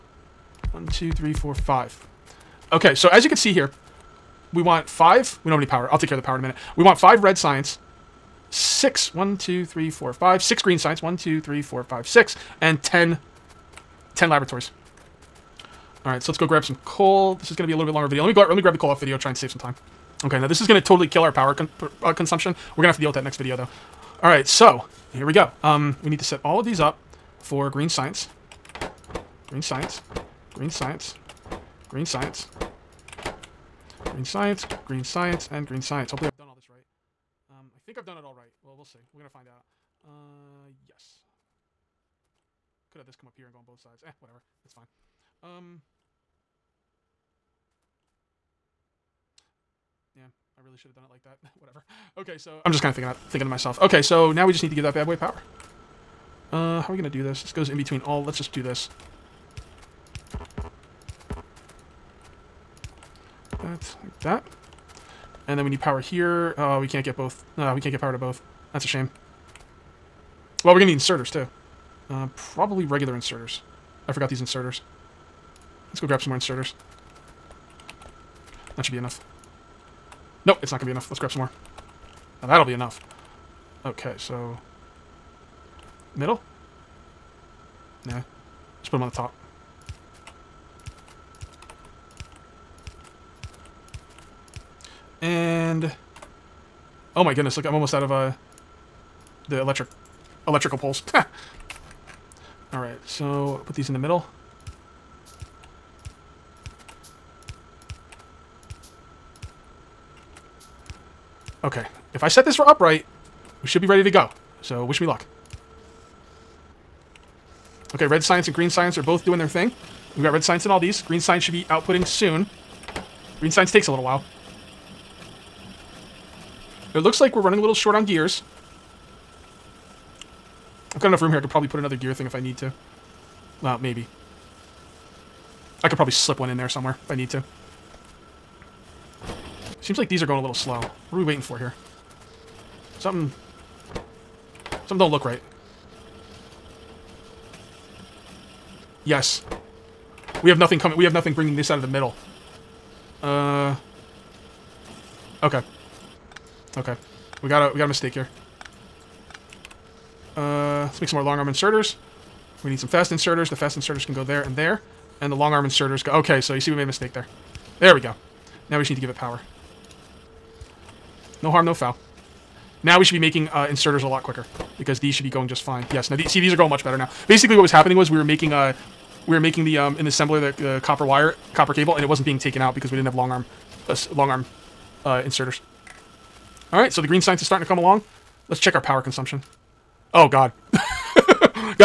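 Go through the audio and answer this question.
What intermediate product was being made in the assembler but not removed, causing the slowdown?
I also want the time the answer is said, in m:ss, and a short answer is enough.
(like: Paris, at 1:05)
copper cable, at 3:01.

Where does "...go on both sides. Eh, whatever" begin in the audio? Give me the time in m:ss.
0:43.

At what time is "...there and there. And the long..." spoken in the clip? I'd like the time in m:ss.
2:44.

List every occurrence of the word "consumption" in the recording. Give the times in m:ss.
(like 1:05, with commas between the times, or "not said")
0:22, 3:09.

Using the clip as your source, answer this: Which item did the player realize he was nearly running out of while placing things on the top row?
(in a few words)
electrical poles.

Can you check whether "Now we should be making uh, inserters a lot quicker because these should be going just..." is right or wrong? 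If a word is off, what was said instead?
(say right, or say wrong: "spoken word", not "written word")
right.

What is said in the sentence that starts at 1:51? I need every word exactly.
Okay, if I set this for upright, we should be ready to go.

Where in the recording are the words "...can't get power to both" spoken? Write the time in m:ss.
1:07.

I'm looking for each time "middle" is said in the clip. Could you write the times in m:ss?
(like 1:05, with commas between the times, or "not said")
1:26, 1:43, 2:31.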